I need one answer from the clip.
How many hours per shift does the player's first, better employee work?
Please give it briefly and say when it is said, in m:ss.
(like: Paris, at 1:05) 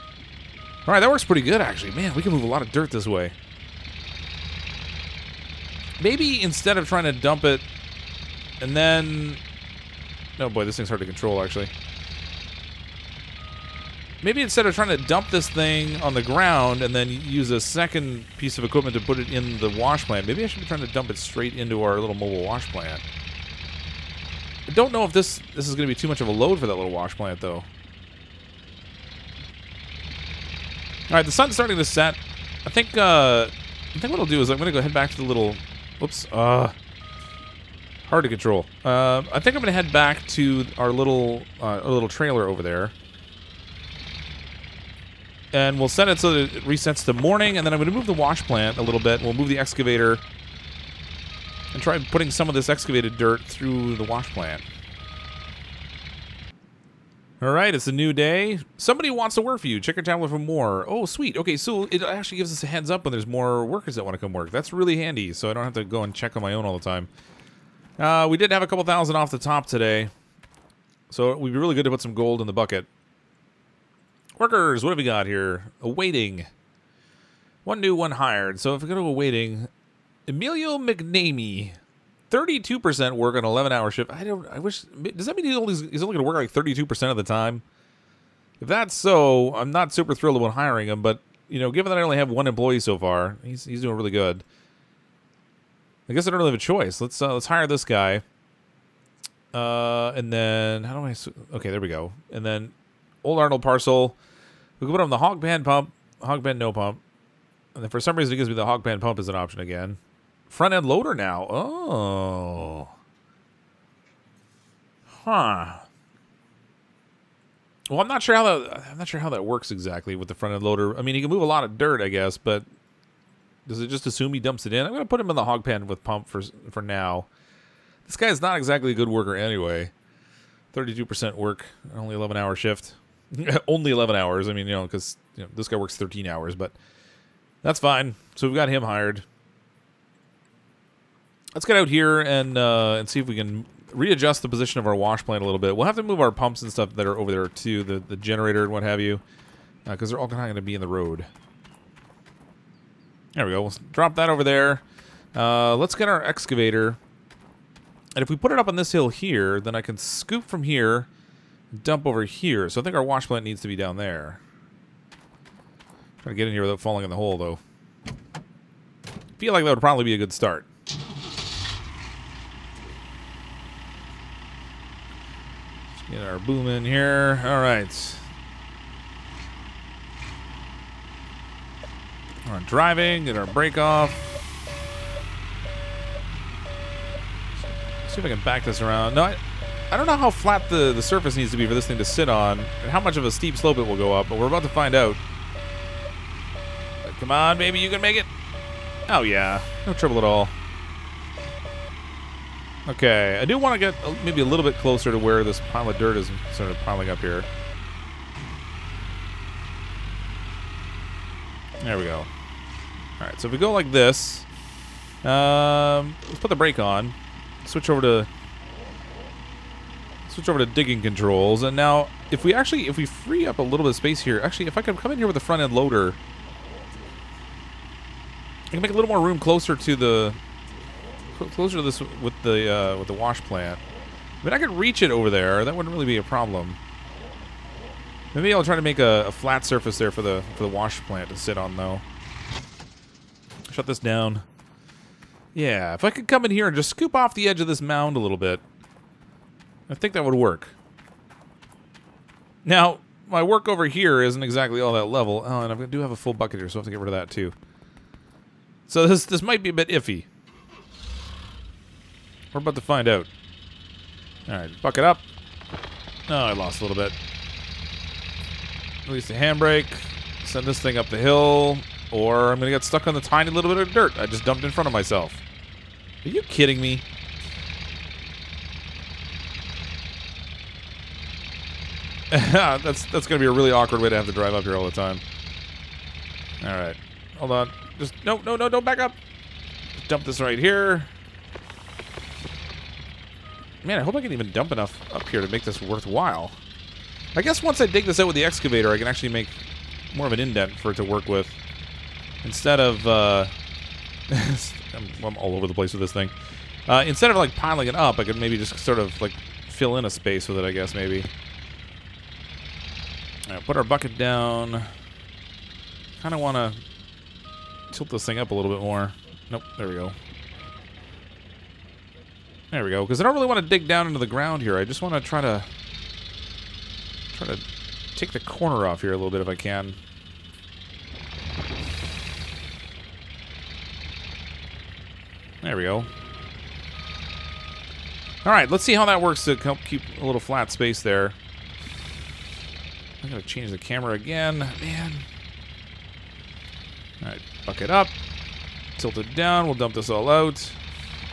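13 hours, at 2:15.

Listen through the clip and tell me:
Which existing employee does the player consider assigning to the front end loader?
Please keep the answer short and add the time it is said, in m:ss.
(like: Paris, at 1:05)
Arnold Parcel, at 1:43.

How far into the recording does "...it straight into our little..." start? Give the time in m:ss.
0:21.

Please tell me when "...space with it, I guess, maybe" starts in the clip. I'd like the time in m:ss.
5:10.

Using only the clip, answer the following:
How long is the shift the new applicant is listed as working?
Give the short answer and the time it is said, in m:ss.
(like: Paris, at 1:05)
11 hours, at 1:23.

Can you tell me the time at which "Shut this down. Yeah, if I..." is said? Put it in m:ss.
4:03.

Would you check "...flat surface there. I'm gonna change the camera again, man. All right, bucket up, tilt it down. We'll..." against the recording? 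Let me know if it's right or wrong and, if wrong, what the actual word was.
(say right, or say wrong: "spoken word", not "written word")
wrong: "space", not "surface".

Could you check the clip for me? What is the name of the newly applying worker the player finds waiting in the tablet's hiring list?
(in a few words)
Emilio McNamee.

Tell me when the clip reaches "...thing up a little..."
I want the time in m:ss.
5:18.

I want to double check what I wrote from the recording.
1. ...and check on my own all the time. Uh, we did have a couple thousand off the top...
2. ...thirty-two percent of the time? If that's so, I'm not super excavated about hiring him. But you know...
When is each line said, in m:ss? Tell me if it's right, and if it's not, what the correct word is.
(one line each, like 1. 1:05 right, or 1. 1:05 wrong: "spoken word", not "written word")
1. 1:06 right
2. 1:26 wrong: "thrilled", not "excavated".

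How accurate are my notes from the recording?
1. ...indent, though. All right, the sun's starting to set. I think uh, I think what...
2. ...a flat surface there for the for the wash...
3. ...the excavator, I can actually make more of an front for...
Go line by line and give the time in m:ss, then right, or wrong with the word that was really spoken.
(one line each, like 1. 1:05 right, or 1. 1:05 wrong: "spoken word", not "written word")
1. 0:27 wrong: "plant", not "indent"
2. 3:59 right
3. 4:58 wrong: "indent", not "front".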